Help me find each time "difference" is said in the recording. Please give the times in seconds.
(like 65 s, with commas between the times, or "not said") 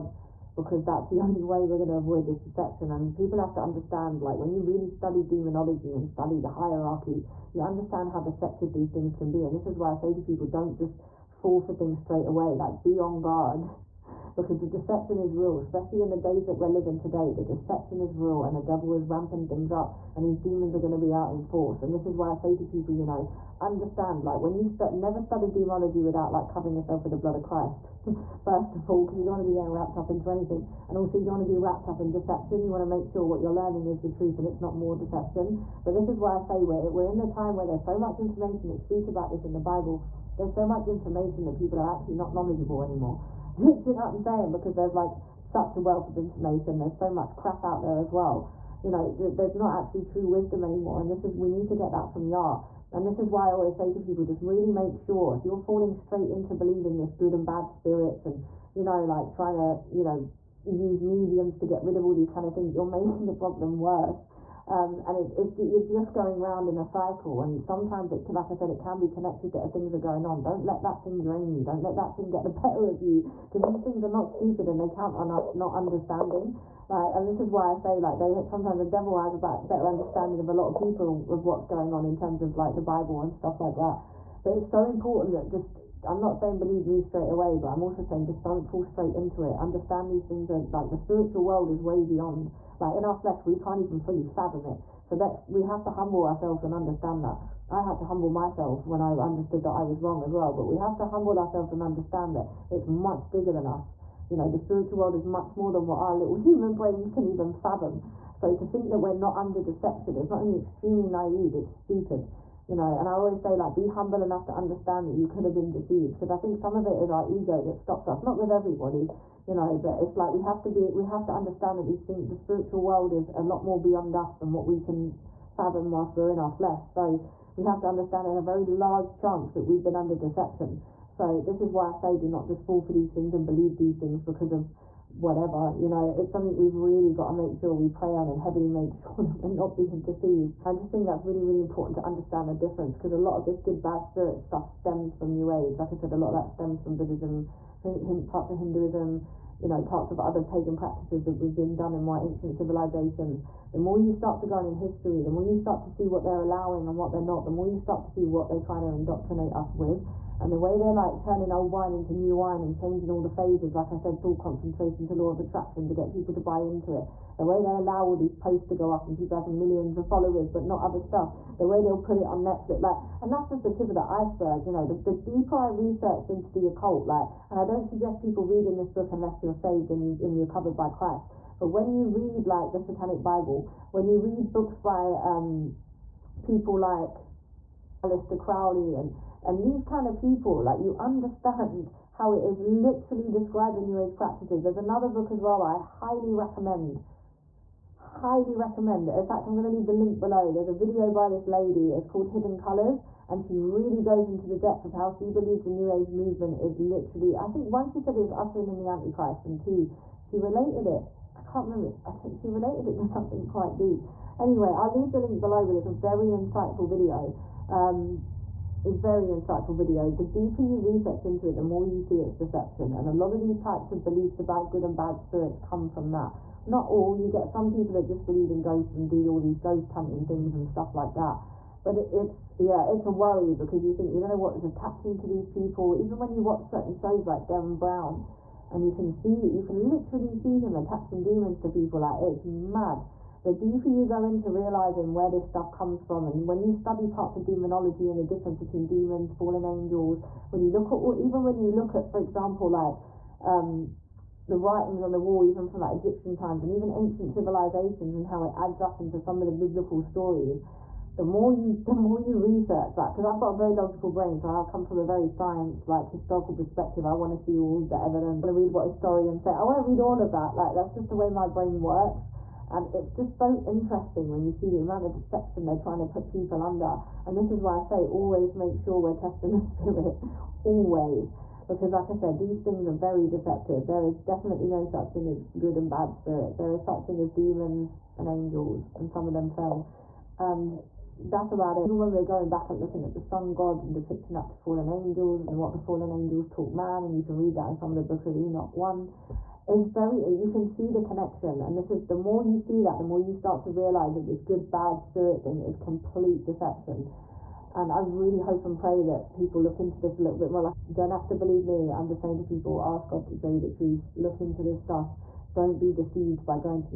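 142 s, 248 s.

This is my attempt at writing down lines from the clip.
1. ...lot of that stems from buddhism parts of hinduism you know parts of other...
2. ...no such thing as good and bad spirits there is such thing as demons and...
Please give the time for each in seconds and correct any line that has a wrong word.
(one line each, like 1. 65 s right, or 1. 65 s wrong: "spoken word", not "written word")
1. 146 s right
2. 284 s right.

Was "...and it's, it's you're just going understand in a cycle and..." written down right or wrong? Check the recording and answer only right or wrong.
wrong.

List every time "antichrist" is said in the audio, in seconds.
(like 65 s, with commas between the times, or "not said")
208 s.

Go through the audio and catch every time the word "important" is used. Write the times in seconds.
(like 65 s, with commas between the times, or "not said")
84 s, 141 s.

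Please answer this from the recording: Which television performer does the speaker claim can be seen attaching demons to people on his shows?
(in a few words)
Derren Brown.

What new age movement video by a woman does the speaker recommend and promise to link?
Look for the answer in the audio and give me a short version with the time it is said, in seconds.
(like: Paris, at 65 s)
Hidden Colors, at 202 s.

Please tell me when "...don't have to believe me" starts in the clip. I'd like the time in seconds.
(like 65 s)
310 s.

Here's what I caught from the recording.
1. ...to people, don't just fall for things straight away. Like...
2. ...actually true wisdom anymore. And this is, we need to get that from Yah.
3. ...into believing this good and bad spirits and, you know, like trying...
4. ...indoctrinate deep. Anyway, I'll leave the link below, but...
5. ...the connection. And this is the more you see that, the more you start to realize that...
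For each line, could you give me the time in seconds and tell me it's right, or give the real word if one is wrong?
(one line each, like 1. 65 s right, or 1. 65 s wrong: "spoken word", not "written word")
1. 10 s right
2. 49 s right
3. 56 s right
4. 213 s wrong: "quite", not "indoctrinate"
5. 300 s right.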